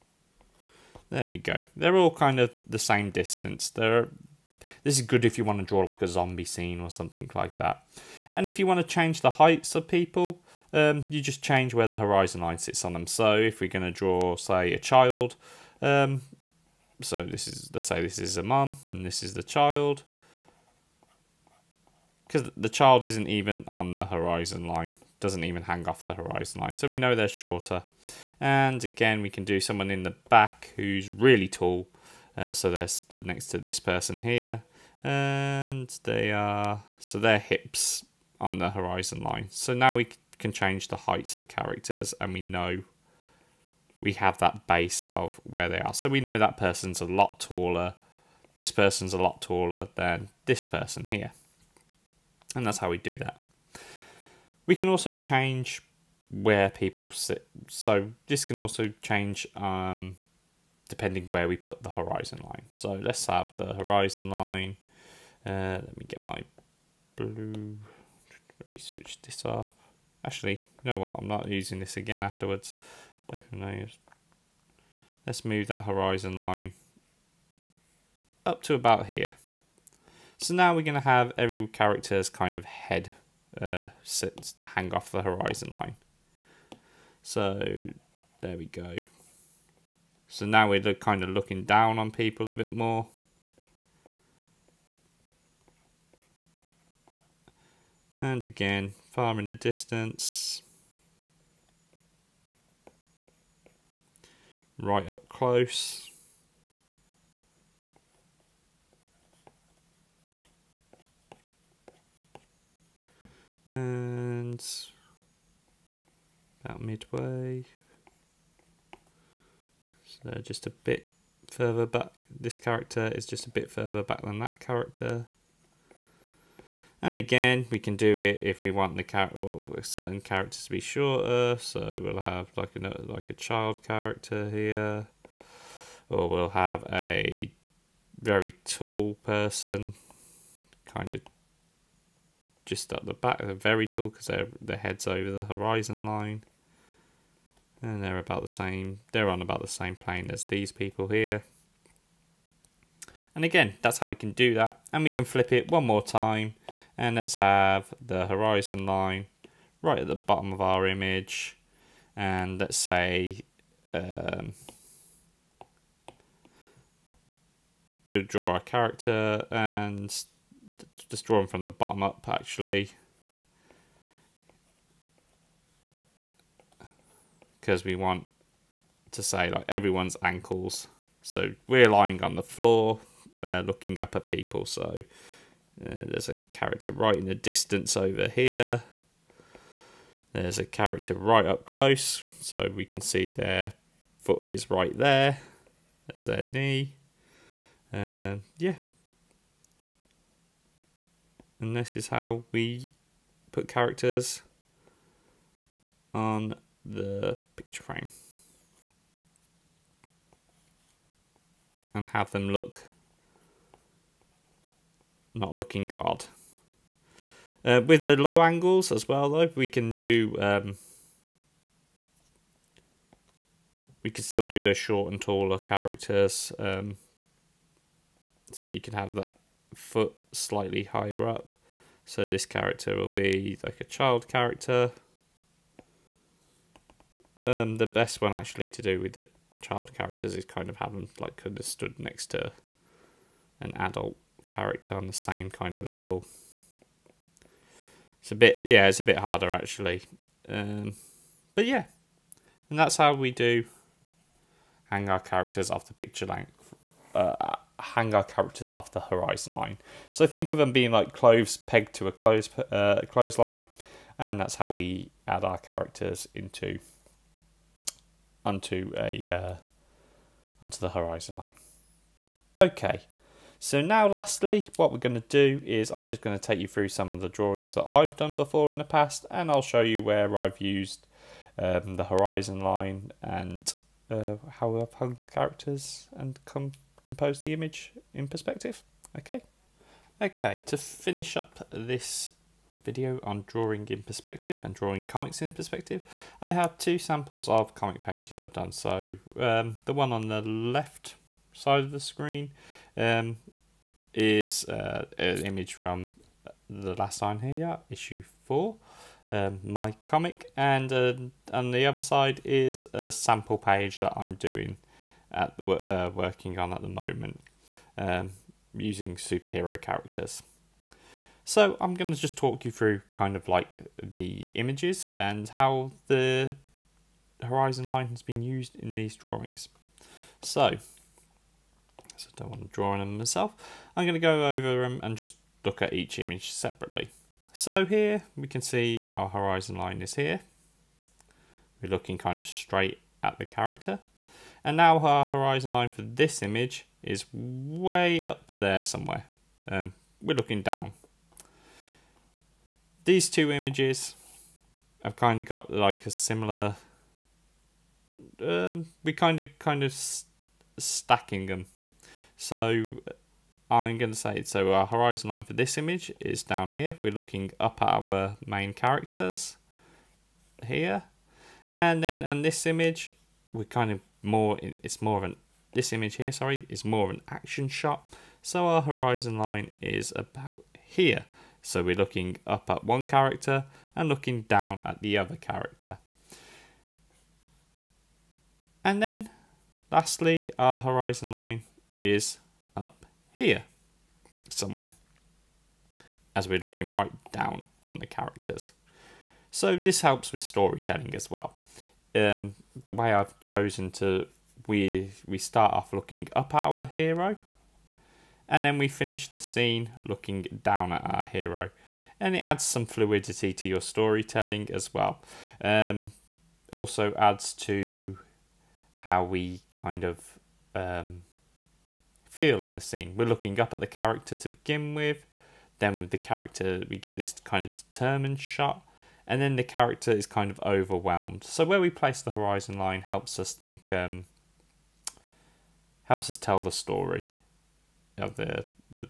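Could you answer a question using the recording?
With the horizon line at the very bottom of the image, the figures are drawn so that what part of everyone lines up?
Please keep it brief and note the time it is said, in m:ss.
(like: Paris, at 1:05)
Ankles, at 3:00.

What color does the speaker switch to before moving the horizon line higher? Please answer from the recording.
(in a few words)
Blue.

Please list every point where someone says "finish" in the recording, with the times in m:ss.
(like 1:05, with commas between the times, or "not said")
4:50, 6:48.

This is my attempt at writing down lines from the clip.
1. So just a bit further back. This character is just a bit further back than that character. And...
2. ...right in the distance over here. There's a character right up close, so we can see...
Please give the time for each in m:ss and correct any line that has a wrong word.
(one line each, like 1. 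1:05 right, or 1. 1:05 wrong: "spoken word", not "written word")
1. 2:00 right
2. 3:06 right.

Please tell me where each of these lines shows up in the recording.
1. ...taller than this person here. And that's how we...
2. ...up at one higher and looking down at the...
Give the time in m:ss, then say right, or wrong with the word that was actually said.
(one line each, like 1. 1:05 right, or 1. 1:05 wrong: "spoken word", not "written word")
1. 0:49 right
2. 6:22 wrong: "character", not "higher".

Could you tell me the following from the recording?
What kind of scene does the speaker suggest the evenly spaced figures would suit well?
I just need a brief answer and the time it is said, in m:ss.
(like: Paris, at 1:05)
A zombie scene, at 0:06.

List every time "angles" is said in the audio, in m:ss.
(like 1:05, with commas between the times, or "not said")
3:38.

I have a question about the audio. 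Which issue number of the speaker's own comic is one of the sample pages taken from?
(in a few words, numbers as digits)
4.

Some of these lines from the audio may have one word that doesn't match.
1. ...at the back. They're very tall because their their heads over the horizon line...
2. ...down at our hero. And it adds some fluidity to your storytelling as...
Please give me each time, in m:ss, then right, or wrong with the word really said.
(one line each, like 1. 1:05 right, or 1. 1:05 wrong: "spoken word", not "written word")
1. 2:22 right
2. 6:50 right.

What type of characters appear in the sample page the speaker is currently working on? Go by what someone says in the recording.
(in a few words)
Superhero characters.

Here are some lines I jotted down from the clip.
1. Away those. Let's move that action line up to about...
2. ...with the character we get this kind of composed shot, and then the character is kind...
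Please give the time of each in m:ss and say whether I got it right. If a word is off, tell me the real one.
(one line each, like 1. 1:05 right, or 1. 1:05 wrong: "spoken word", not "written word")
1. 1:13 wrong: "horizon", not "action"
2. 7:05 wrong: "determined", not "composed".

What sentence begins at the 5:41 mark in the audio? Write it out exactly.
We're looking kind of straight at the character.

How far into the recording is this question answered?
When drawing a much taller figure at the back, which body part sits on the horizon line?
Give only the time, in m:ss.
0:37.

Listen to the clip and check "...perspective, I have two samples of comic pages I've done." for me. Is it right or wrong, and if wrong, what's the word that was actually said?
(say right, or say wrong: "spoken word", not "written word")
right.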